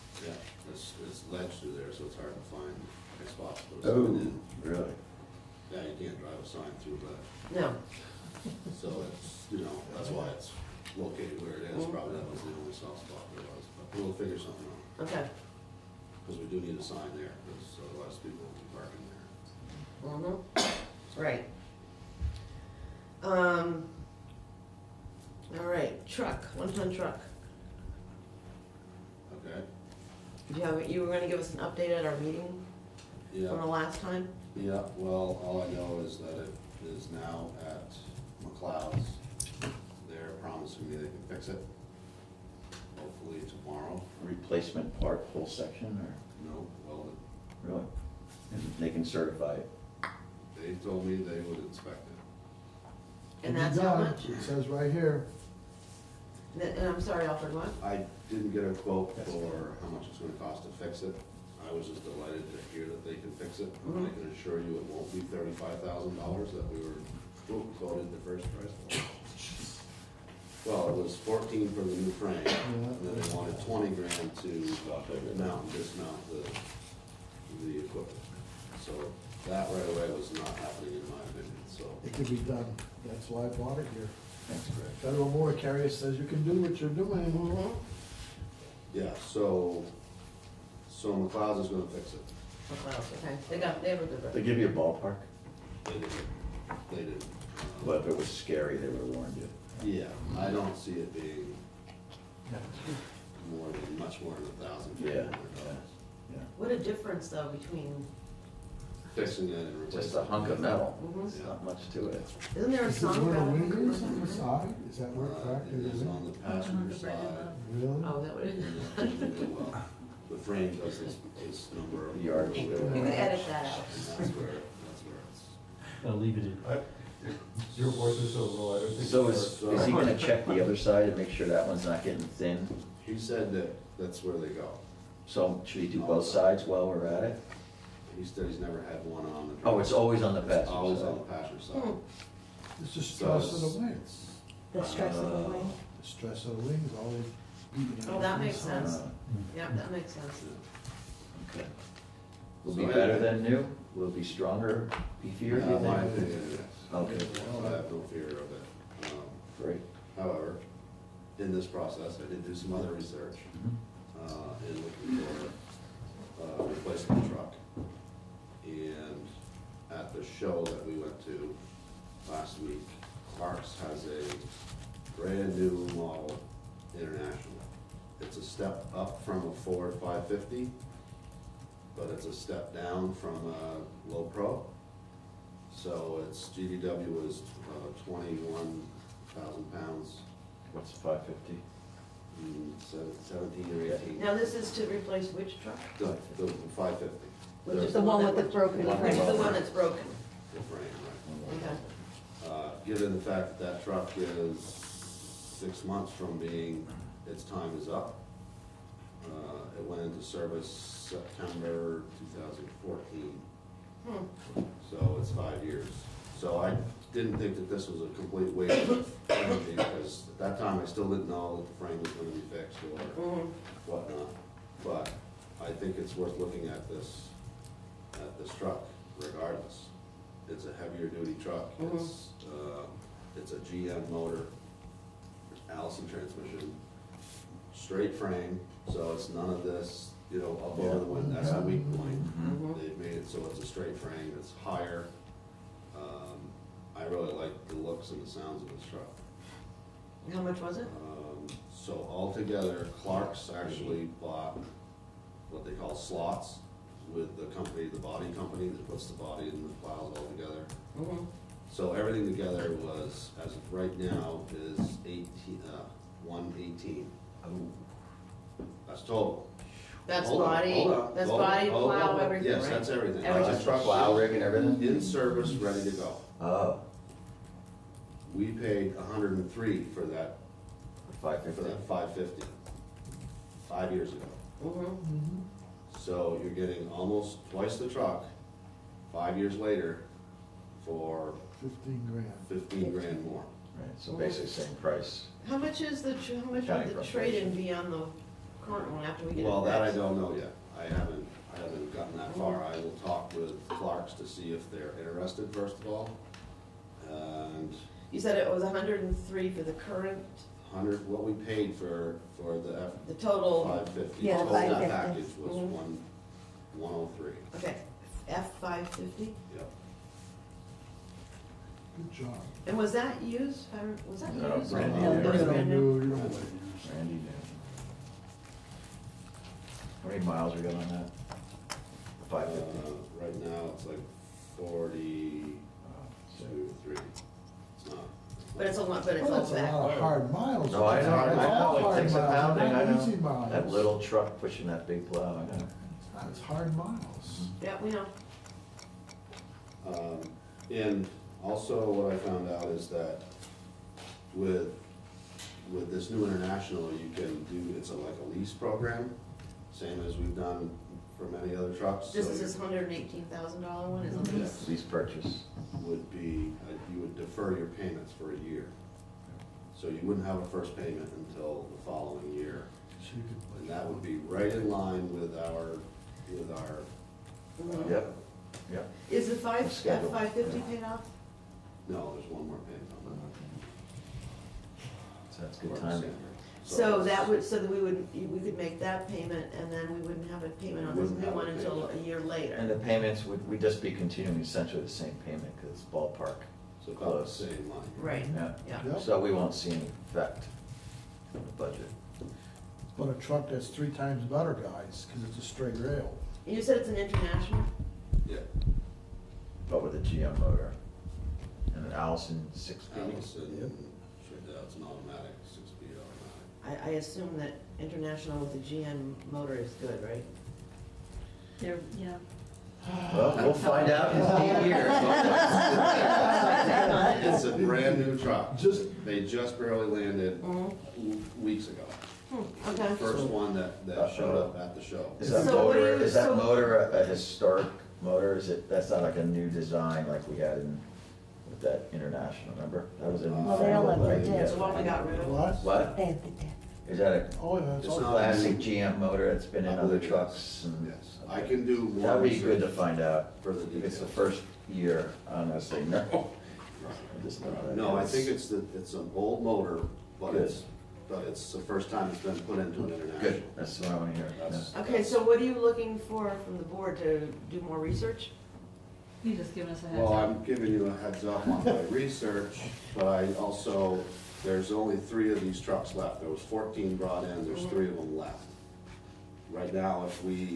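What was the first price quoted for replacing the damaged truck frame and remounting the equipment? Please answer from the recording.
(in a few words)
$35,000.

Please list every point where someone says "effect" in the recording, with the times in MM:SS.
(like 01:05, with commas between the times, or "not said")
06:40.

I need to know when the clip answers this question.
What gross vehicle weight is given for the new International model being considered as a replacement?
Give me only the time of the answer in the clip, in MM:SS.
03:08.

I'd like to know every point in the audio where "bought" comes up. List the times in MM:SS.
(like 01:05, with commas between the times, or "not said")
01:23, 04:14.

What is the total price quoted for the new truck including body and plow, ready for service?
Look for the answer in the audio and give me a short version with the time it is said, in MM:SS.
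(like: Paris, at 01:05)
$118,000, at 04:26.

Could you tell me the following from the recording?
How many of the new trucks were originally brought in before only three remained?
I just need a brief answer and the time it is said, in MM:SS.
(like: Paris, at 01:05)
14, at 07:56.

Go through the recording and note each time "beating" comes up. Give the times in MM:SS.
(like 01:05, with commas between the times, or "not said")
02:27.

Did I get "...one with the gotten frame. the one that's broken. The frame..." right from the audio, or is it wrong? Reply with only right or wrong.
wrong.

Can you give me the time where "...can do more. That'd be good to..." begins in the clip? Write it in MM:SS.
07:31.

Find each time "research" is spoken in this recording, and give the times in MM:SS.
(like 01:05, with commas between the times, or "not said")
02:42, 07:47, 07:51.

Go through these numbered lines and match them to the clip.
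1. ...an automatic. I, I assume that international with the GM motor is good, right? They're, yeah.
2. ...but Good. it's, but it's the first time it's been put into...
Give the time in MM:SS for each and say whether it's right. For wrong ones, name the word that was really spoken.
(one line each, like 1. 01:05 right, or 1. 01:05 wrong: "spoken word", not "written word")
1. 06:54 right
2. 07:40 right.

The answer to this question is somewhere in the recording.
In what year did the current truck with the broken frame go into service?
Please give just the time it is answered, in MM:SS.
03:32.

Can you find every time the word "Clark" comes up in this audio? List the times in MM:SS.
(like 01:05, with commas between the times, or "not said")
02:53, 04:13, 05:03.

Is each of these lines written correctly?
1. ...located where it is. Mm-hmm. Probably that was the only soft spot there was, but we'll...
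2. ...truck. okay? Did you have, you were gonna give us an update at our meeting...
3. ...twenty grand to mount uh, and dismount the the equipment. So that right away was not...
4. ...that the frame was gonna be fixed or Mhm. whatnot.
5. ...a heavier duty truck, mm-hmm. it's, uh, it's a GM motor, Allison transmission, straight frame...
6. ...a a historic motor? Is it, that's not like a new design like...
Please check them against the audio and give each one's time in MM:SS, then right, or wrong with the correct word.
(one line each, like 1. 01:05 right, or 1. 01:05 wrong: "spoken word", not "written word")
1. 00:10 right
2. 00:26 right
3. 01:13 right
4. 03:41 right
5. 03:50 right
6. 07:16 right.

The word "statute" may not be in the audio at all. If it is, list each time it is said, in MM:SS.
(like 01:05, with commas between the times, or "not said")
not said.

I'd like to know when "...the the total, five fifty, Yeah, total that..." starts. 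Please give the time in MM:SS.
05:12.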